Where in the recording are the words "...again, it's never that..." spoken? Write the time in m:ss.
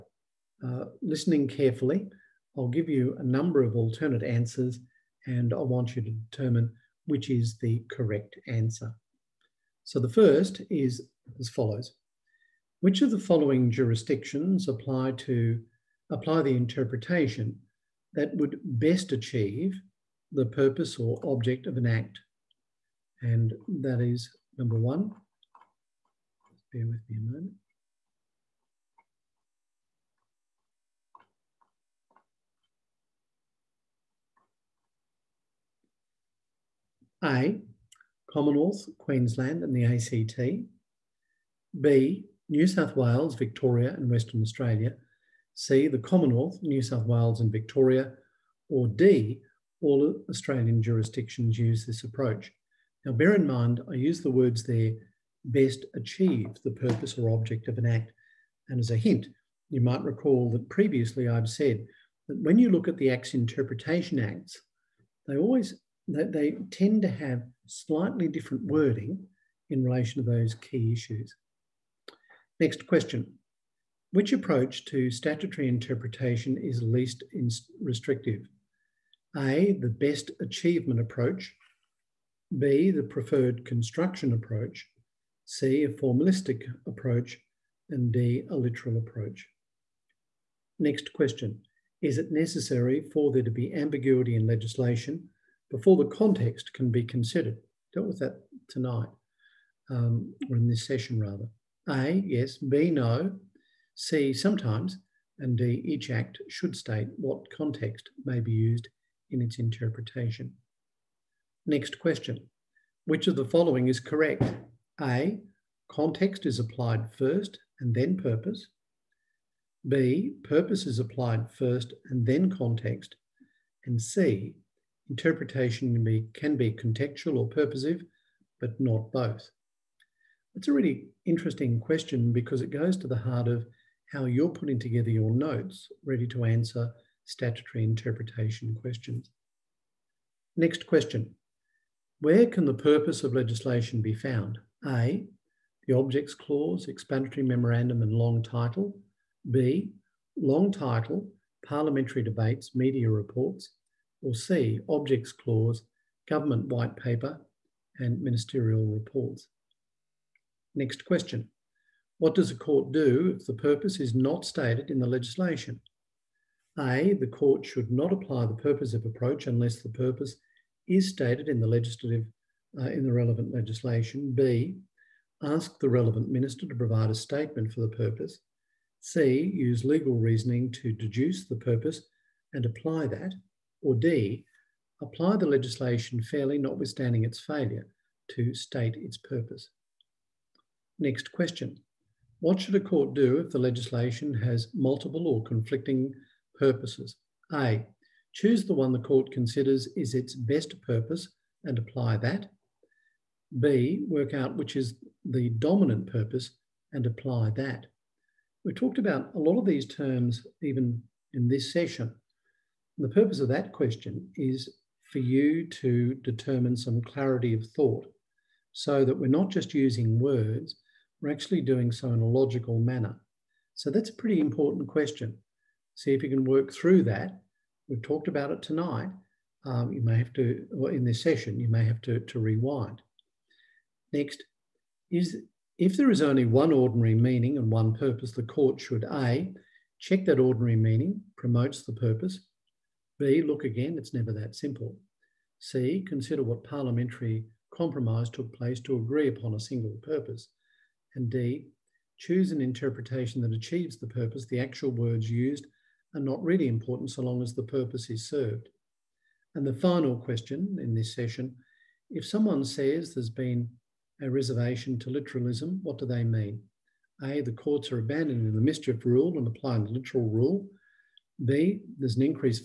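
4:03.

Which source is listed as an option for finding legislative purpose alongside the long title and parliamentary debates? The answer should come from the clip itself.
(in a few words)
Media reports.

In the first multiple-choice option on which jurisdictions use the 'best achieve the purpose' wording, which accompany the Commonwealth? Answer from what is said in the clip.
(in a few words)
Queensland and the ACT.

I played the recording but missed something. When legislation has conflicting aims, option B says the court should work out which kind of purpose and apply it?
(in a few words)
Dominant purpose.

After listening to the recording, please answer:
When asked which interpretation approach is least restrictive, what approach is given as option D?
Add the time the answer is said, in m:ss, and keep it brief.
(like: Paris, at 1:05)
A literal approach, at 1:28.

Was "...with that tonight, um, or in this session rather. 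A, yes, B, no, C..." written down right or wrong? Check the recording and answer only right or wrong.
right.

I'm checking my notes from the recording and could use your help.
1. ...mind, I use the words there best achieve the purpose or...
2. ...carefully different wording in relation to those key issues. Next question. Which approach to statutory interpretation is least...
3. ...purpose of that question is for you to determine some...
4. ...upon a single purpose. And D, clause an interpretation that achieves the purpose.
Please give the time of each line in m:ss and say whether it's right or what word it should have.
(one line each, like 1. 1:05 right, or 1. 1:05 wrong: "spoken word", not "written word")
1. 0:53 right
2. 1:07 wrong: "slightly", not "carefully"
3. 3:33 right
4. 4:09 wrong: "choose", not "clause".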